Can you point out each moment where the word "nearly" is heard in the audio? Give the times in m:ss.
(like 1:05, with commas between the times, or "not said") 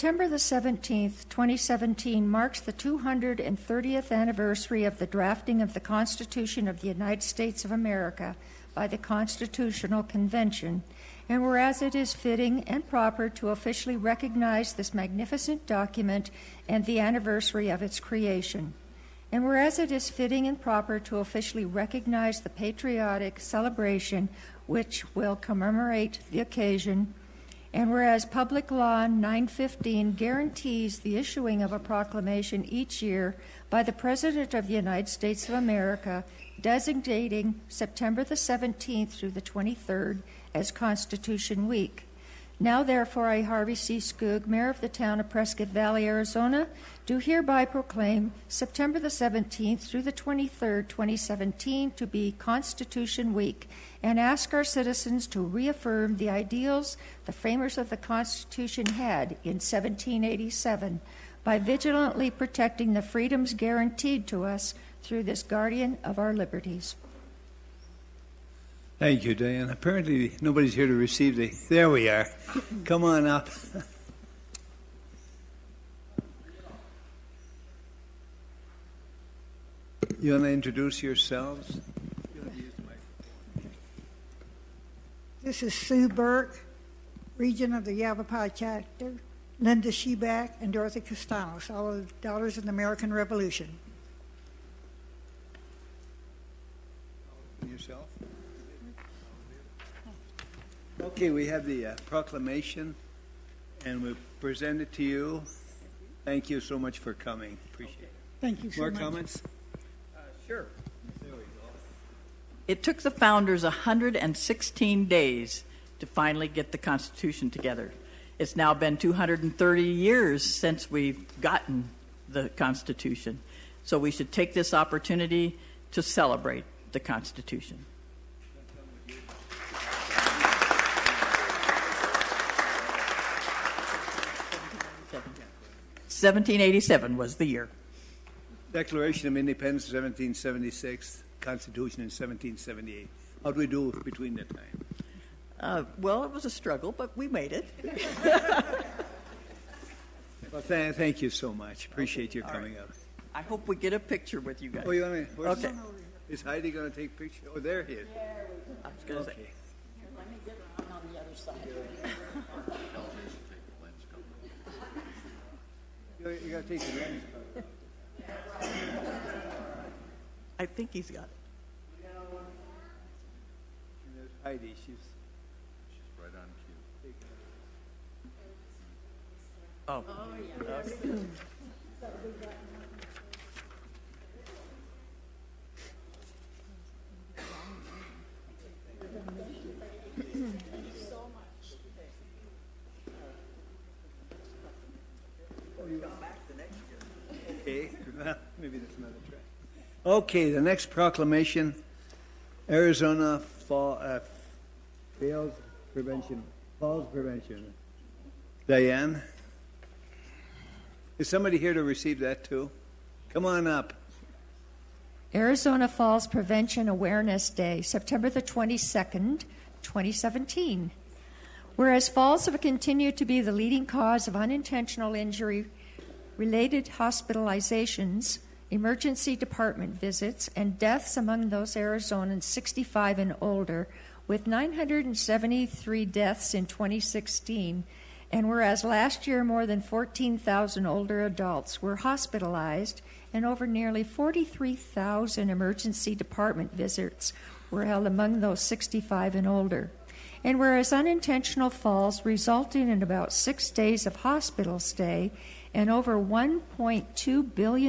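4:03.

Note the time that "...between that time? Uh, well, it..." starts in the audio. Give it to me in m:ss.
2:24.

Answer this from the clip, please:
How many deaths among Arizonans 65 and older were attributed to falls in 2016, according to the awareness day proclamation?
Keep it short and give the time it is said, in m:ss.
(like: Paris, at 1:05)
973, at 3:54.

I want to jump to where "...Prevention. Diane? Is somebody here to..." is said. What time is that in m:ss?
3:27.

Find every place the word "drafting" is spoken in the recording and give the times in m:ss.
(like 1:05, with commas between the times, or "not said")
0:05.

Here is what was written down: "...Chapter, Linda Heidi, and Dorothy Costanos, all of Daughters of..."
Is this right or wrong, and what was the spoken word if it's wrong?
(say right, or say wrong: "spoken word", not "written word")
wrong: "Sheback", not "Heidi".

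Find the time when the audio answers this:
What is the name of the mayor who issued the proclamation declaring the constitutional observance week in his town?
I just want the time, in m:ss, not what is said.
0:43.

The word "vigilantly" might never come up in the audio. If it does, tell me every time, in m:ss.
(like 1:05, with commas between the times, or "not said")
1:01.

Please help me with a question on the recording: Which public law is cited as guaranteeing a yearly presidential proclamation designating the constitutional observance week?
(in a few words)
Public Law 915.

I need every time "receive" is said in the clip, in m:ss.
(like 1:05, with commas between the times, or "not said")
1:10, 3:31.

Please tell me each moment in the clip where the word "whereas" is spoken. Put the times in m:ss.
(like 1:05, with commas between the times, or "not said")
0:11, 0:19, 0:27, 3:41, 3:58, 4:10.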